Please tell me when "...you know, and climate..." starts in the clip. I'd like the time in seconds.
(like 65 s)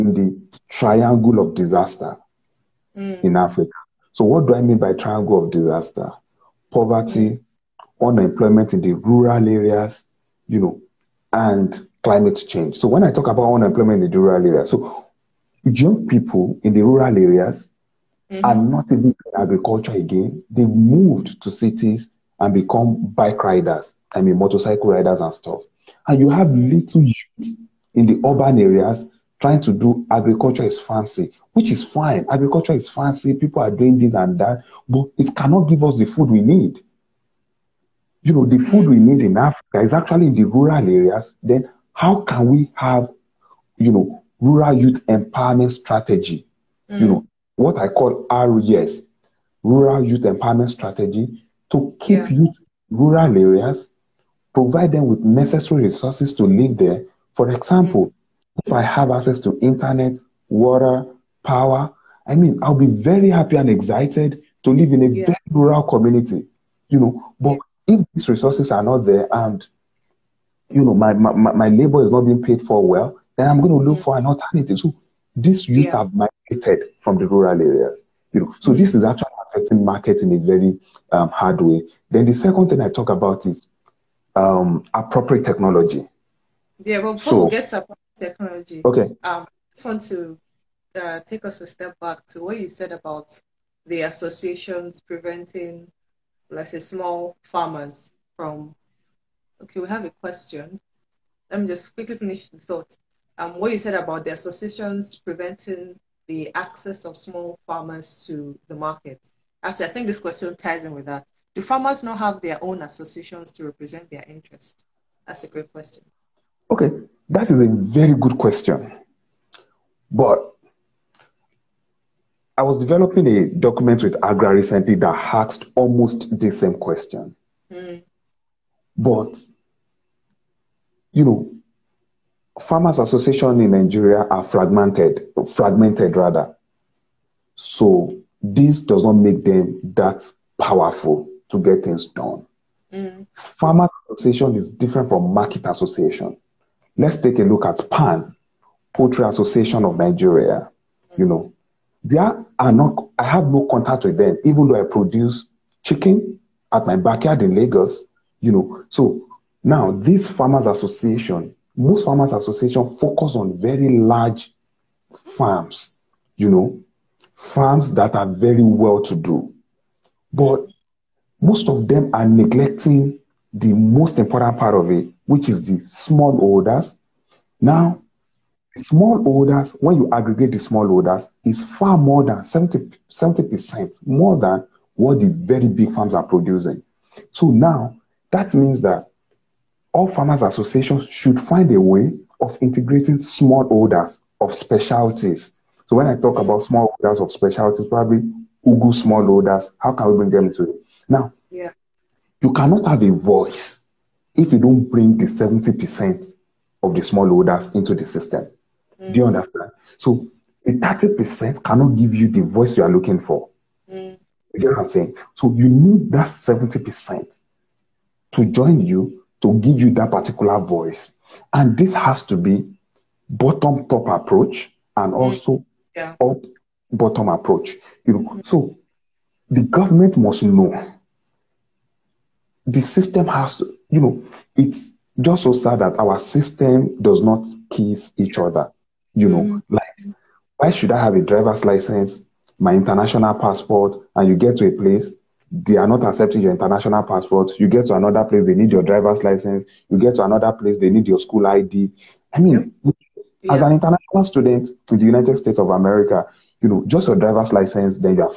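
10 s.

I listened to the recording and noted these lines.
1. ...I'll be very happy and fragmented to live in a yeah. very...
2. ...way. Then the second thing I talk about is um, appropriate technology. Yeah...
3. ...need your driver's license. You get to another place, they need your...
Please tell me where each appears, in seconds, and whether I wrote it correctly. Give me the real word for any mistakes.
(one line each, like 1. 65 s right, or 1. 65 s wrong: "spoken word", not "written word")
1. 62 s wrong: "excited", not "fragmented"
2. 81 s right
3. 248 s right.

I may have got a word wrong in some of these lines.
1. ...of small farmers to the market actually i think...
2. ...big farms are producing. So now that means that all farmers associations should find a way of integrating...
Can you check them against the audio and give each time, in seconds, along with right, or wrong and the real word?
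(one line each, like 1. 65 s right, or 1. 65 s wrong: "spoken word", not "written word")
1. 107 s right
2. 185 s right.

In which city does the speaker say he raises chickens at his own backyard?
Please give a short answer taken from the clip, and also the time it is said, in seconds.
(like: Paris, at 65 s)
Lagos, at 157 s.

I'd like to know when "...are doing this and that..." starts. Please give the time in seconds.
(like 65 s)
33 s.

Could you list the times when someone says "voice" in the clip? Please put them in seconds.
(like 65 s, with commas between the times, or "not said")
203 s, 212 s, 220 s.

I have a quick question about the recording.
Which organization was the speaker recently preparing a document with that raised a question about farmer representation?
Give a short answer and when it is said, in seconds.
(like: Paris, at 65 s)
Agra, at 124 s.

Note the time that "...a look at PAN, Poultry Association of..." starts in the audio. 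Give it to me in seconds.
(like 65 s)
147 s.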